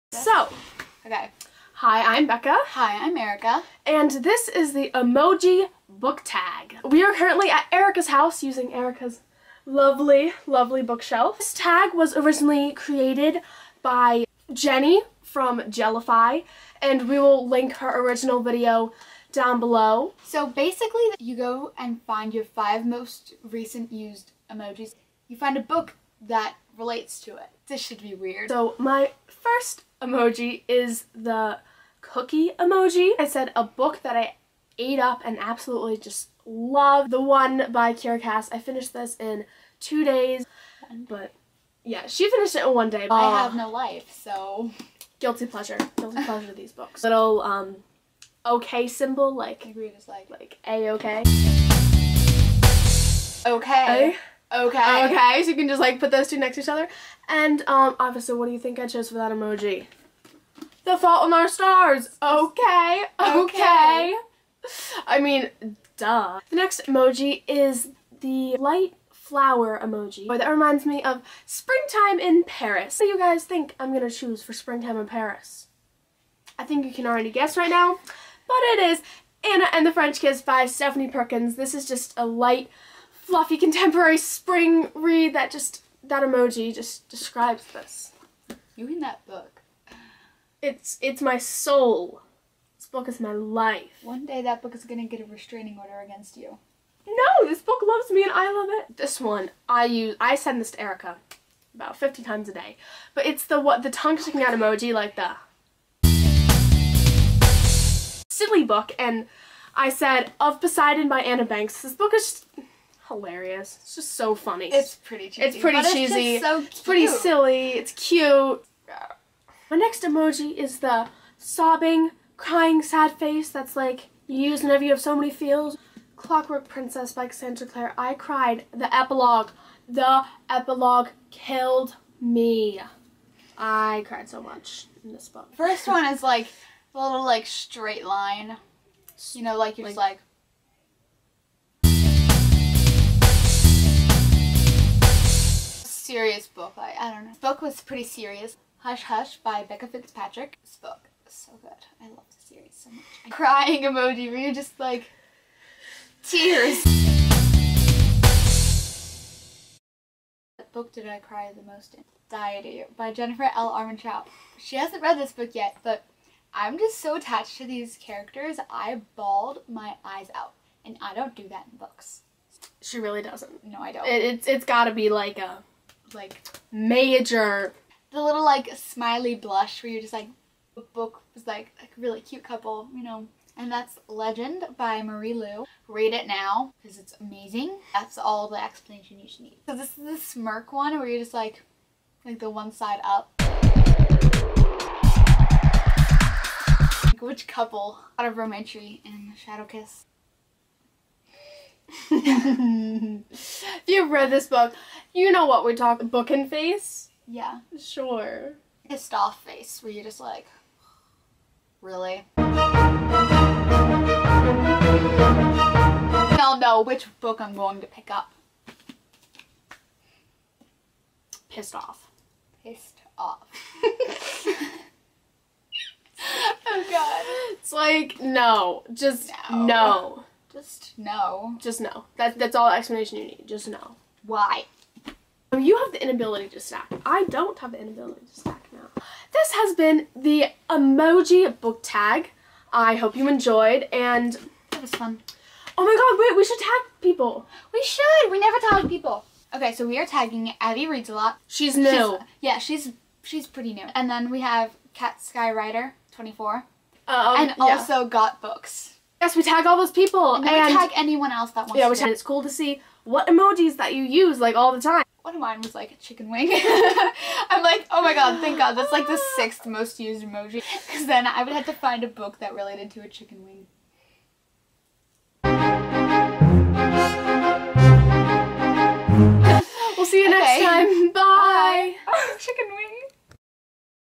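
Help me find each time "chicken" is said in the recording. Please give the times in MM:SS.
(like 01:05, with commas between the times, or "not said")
04:25, 04:33, 04:42.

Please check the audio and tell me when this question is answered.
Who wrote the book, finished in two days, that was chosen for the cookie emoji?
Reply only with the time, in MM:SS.
00:37.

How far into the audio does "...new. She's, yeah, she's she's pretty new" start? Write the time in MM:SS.
04:11.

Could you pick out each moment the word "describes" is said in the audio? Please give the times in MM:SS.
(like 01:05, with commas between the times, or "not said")
01:27.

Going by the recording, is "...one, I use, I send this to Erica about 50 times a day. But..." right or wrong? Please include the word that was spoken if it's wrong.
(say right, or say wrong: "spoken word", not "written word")
right.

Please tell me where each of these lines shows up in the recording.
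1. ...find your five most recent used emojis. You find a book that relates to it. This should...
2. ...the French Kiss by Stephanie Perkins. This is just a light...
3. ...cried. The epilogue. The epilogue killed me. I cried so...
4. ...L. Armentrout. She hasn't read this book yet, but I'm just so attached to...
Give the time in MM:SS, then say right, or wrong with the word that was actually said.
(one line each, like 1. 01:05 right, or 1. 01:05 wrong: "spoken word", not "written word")
1. 00:22 right
2. 01:19 right
3. 02:08 right
4. 02:43 right.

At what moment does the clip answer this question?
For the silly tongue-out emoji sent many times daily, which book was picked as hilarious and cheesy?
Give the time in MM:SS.
01:50.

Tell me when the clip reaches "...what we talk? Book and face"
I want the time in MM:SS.
03:25.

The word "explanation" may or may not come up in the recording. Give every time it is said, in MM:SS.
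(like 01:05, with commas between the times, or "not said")
03:08, 03:52.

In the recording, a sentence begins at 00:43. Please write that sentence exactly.
I uh, have no life, so...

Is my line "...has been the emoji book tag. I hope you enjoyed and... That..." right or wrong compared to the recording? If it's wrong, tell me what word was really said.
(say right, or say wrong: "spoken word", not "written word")
right.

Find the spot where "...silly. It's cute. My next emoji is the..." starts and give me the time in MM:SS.
01:57.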